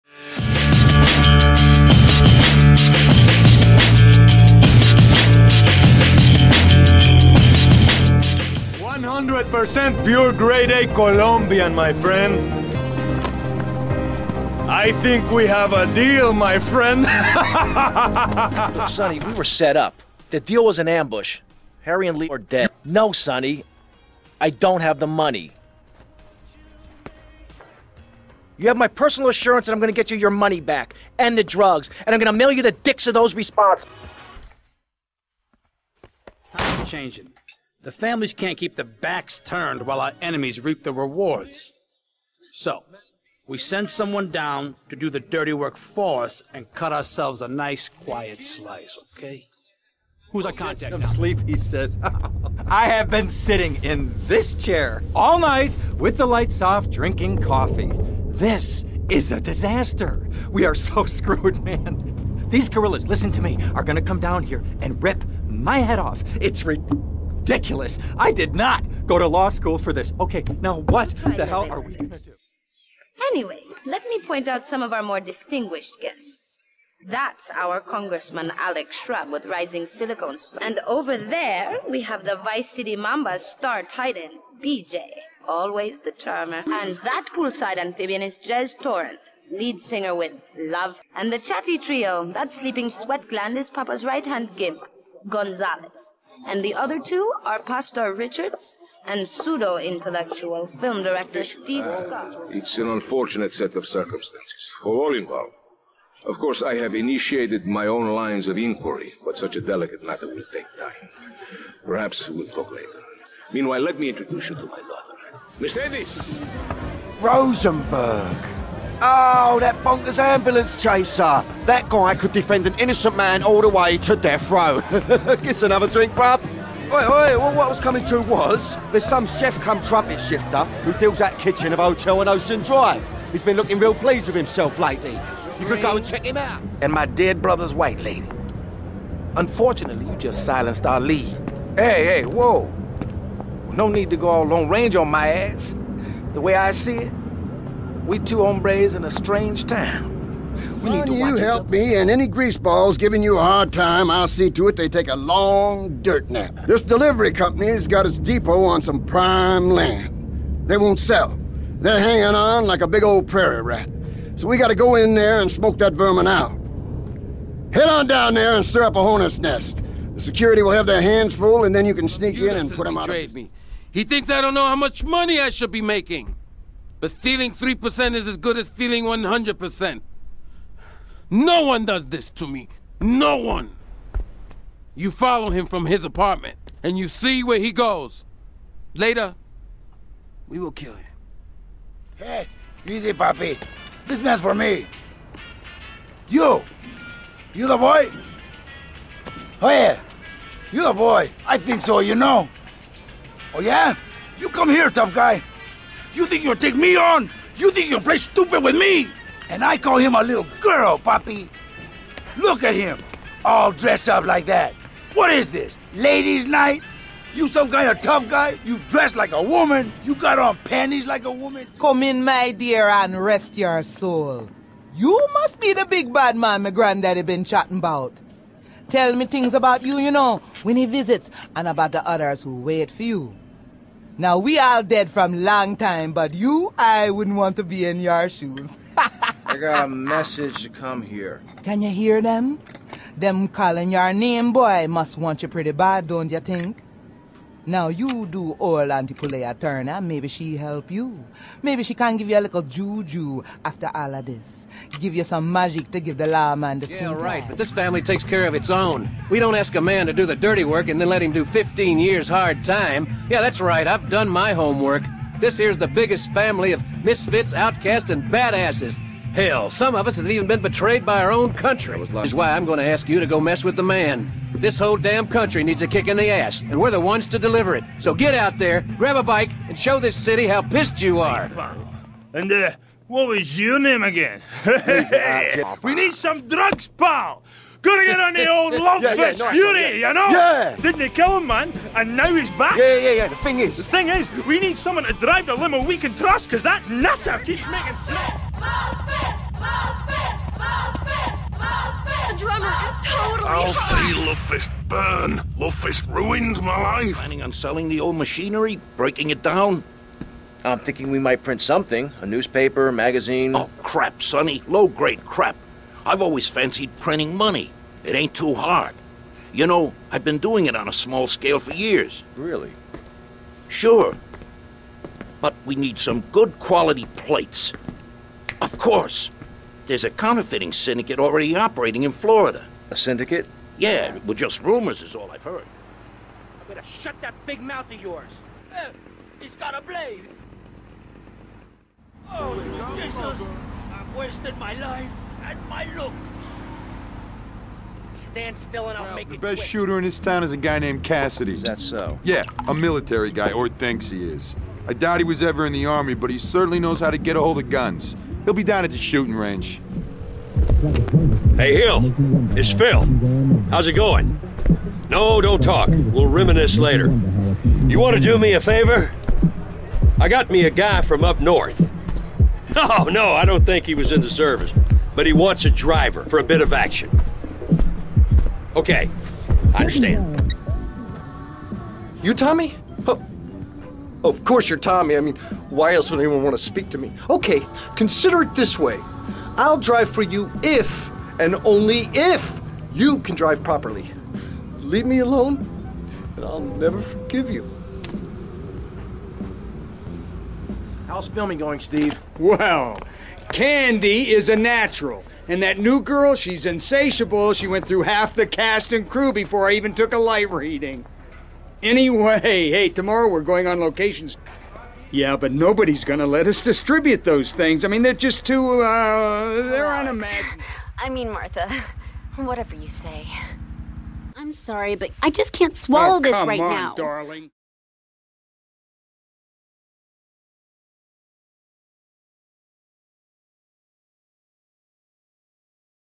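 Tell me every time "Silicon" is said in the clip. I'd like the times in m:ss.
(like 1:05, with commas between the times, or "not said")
1:19.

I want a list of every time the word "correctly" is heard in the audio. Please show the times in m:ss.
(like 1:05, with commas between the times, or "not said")
not said.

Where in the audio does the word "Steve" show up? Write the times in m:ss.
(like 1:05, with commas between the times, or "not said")
1:41, 6:41.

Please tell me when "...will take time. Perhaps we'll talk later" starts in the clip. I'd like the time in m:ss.
1:50.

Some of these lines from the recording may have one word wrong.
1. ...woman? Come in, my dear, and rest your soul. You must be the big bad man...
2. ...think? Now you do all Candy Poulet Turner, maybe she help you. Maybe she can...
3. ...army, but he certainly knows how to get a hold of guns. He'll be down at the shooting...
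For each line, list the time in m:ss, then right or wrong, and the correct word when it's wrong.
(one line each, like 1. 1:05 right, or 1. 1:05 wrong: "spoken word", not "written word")
1. 3:41 right
2. 4:06 wrong: "Auntie", not "Candy"
3. 5:55 right.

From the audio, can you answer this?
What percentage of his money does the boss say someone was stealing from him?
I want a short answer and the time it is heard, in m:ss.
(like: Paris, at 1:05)
3%, at 2:57.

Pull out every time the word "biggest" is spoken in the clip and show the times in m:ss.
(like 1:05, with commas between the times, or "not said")
4:25.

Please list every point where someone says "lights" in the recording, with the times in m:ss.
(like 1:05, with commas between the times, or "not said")
0:56, 6:50.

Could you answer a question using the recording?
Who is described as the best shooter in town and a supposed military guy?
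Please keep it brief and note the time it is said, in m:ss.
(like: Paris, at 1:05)
Cassidy, at 5:51.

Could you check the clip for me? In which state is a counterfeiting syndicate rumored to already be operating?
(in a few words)
Florida.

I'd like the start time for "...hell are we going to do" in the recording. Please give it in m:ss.
1:11.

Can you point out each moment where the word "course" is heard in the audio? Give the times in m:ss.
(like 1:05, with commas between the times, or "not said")
1:46, 5:28, 6:24.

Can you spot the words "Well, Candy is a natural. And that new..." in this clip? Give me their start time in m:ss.
6:42.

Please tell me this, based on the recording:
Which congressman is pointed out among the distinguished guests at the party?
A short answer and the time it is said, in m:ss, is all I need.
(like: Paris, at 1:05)
Alex Shrub, at 1:18.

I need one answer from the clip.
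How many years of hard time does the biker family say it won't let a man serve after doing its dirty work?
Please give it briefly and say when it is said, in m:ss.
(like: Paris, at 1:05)
15, at 4:21.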